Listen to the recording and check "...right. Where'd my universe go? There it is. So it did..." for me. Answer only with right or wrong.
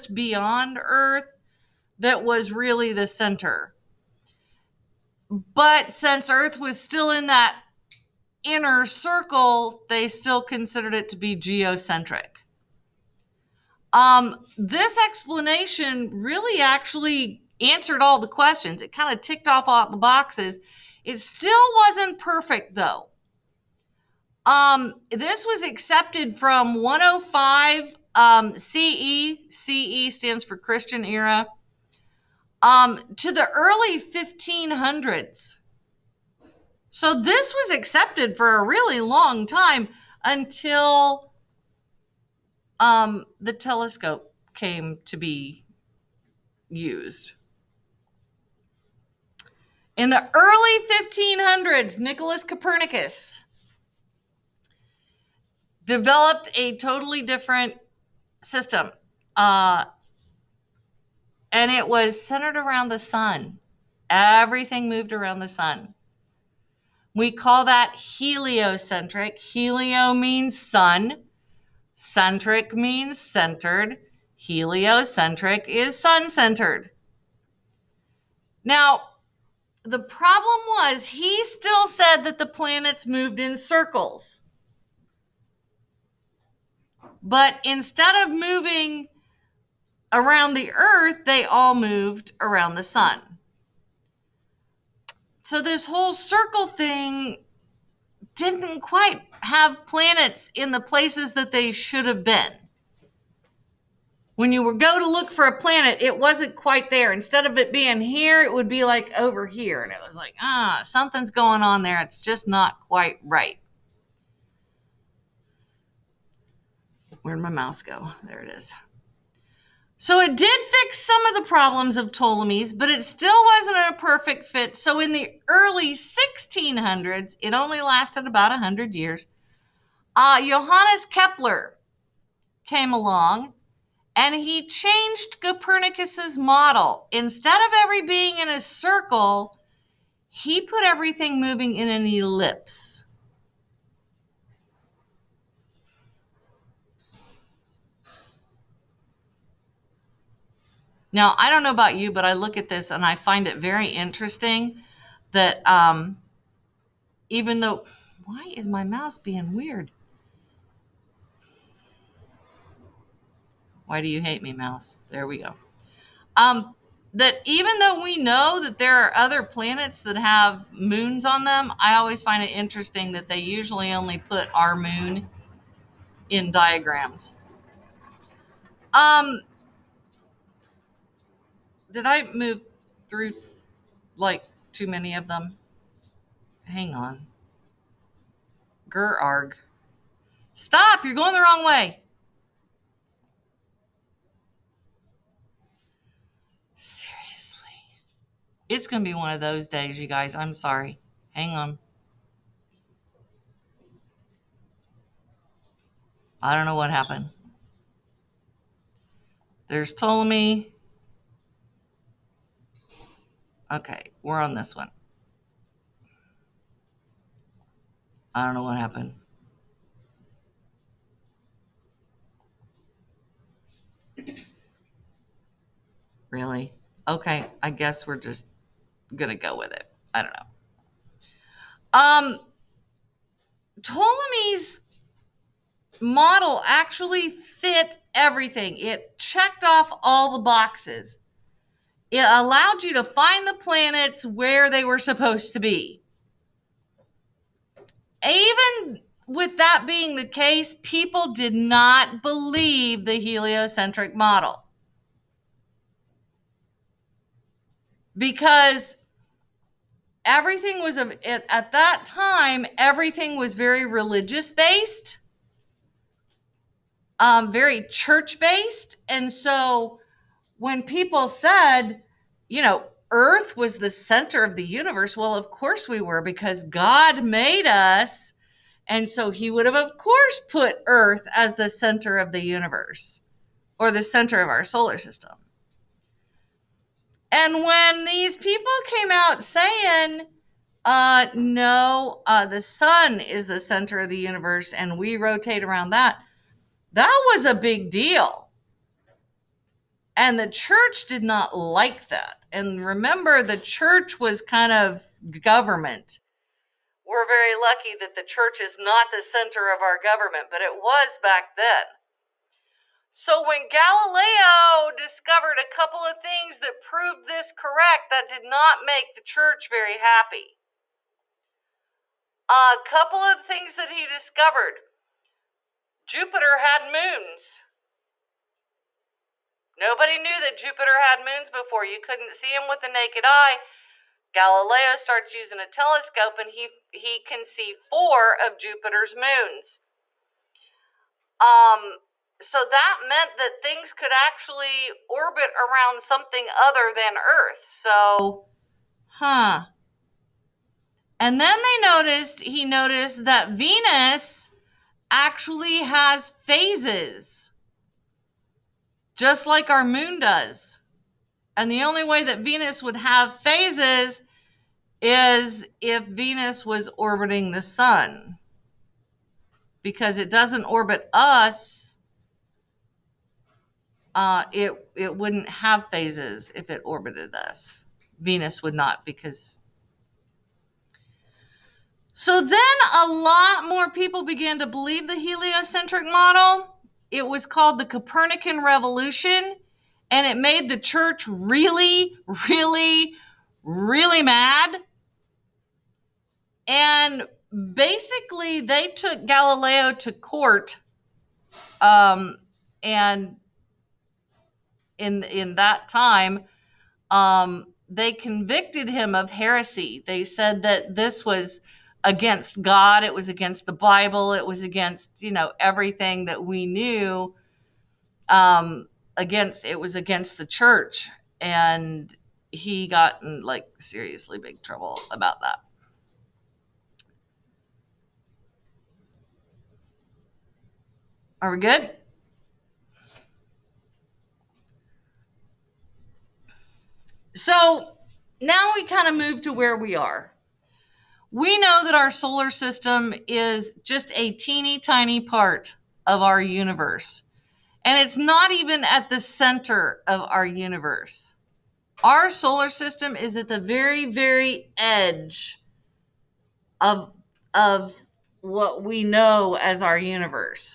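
wrong.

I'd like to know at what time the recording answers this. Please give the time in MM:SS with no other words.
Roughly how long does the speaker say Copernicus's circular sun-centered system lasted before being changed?
02:08.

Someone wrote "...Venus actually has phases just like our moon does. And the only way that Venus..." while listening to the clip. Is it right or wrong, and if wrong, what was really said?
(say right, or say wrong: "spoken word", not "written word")
right.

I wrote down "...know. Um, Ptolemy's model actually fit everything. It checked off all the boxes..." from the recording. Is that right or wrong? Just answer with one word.
right.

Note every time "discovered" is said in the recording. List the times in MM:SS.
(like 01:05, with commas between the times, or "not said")
05:14, 05:24.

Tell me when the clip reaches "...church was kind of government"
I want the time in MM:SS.
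05:03.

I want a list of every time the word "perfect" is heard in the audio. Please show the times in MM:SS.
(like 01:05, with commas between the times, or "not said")
00:22, 02:03.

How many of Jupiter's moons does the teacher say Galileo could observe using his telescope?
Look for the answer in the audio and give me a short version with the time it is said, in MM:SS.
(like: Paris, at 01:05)
4, at 05:37.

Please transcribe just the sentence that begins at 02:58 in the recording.
Um, did I move through like too many of them?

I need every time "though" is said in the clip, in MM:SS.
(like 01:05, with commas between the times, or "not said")
00:22, 02:37, 02:47.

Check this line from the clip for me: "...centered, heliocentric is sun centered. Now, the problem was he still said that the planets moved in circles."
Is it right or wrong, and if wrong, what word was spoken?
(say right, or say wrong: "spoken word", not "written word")
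right.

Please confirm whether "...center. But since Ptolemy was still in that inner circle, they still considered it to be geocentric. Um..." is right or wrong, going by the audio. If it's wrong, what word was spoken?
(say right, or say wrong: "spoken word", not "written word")
wrong: "Earth", not "Ptolemy".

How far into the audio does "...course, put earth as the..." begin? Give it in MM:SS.
04:39.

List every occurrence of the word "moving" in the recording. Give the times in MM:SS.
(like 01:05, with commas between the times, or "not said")
01:28, 02:21.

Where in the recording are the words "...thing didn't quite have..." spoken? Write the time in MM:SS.
01:36.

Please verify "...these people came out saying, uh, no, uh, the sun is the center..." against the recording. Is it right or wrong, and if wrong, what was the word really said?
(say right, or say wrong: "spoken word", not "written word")
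right.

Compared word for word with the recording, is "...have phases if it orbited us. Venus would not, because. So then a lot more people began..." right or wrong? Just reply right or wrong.
right.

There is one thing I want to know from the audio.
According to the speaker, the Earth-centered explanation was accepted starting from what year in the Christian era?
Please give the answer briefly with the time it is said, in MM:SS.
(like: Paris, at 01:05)
105, at 00:26.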